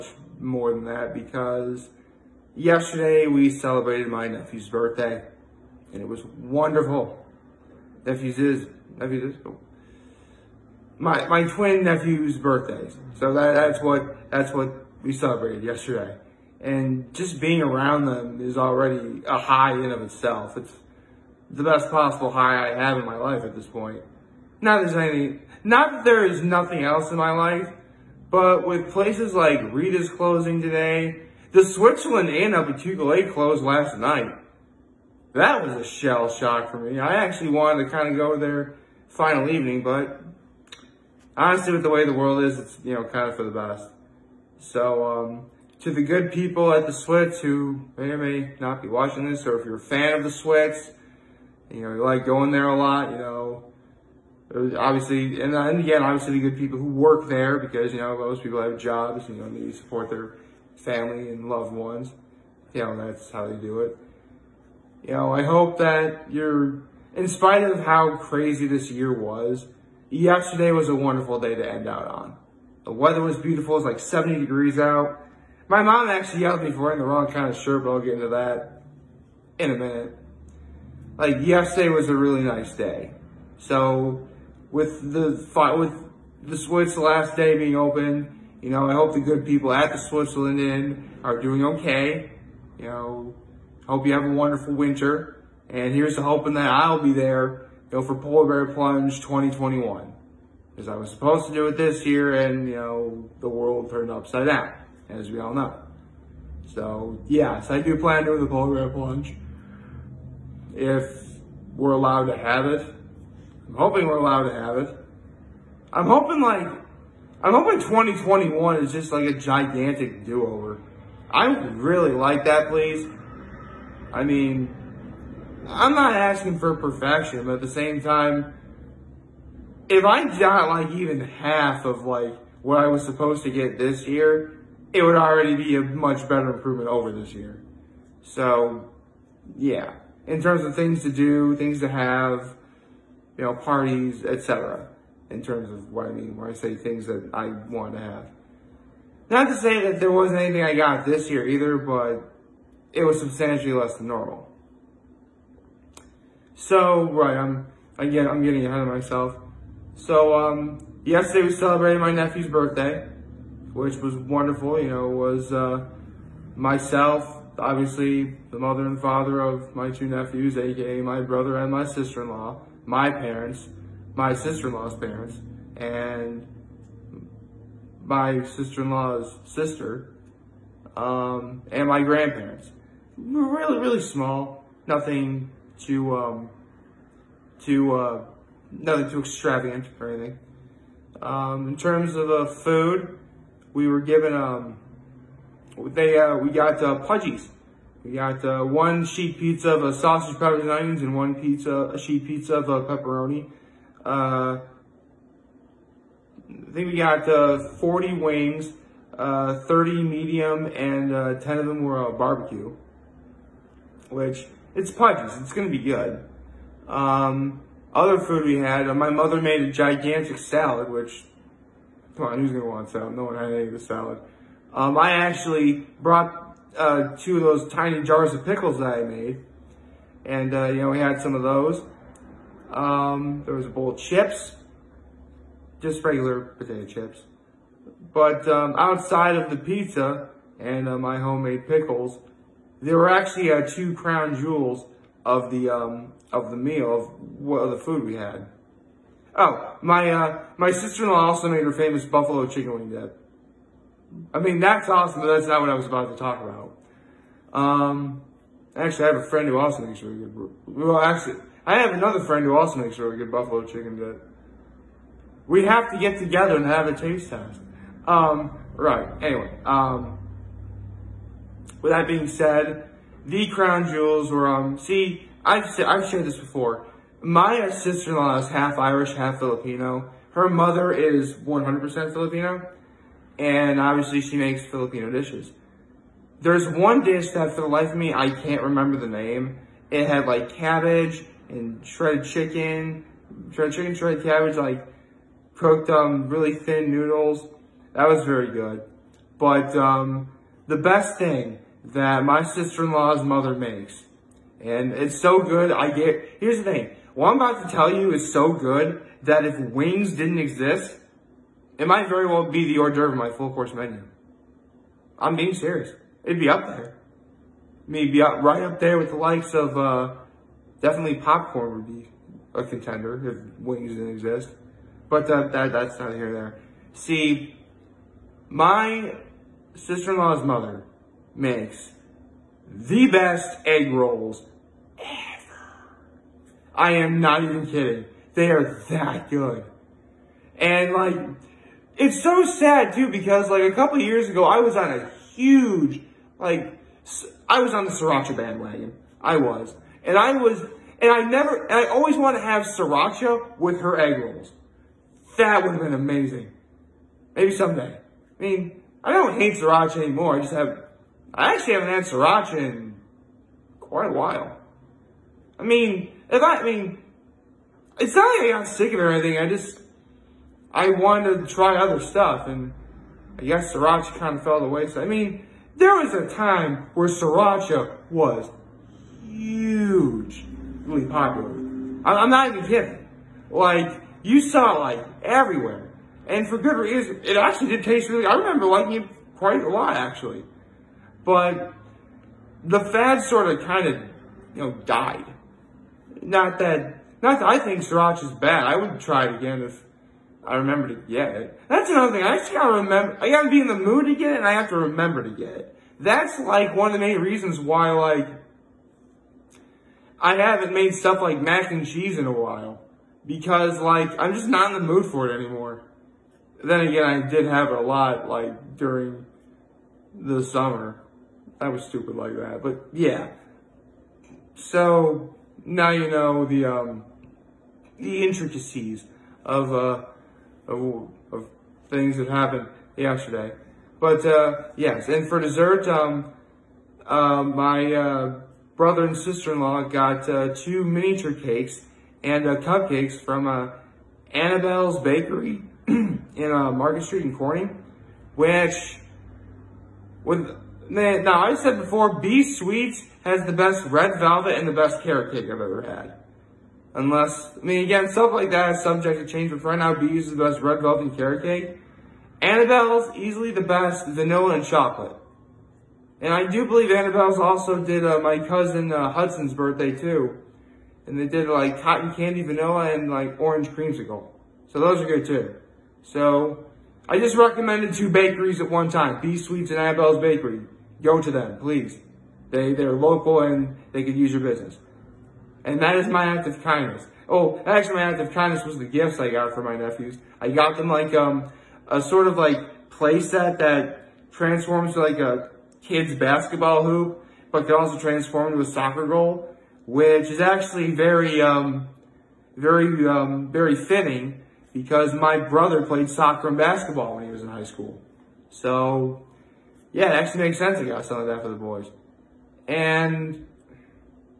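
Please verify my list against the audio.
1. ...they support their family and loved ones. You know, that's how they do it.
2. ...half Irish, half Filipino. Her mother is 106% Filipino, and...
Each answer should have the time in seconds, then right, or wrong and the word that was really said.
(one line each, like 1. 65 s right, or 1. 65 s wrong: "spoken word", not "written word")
1. 59 s right
2. 278 s wrong: "100", not "106".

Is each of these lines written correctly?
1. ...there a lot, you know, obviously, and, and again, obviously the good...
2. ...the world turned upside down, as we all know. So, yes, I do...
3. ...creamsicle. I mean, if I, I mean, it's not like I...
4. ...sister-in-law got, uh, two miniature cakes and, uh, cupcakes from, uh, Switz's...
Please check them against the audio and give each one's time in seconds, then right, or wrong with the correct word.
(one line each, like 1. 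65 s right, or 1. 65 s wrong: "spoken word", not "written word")
1. 52 s right
2. 103 s right
3. 364 s wrong: "while", not "creamsicle"
4. 439 s wrong: "Annabelle", not "Switz".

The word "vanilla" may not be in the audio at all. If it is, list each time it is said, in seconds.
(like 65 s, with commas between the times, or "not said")
464 s, 472 s.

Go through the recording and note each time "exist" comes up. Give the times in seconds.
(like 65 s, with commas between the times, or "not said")
310 s, 324 s.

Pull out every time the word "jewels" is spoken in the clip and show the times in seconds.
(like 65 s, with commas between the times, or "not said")
244 s, 273 s.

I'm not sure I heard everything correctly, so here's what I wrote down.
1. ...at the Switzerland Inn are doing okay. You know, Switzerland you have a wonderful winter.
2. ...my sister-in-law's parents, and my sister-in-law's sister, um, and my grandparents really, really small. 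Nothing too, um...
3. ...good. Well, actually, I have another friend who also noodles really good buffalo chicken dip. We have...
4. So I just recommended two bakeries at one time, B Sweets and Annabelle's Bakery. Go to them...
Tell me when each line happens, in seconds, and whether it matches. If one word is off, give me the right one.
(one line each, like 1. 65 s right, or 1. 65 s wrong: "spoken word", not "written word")
1. 89 s wrong: "Hope", not "Switzerland"
2. 174 s right
3. 260 s wrong: "makes", not "noodles"
4. 476 s right.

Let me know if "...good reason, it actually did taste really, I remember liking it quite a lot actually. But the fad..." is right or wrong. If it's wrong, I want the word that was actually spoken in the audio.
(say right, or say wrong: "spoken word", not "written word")
right.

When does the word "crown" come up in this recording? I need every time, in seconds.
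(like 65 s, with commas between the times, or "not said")
243 s, 273 s.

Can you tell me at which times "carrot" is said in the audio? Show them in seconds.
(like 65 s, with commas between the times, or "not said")
455 s, 461 s.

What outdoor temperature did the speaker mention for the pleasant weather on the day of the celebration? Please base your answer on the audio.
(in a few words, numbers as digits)
70 degrees.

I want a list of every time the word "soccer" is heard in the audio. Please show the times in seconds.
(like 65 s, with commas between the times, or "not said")
498 s, 506 s.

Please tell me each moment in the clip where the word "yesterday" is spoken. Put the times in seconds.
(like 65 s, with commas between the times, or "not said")
2 s, 15 s, 70 s, 81 s, 161 s, 432 s.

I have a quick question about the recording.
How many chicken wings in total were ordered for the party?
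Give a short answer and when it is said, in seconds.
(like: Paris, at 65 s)
40, at 207 s.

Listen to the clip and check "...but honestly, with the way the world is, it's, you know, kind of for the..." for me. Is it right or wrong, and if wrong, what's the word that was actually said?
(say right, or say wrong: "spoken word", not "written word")
right.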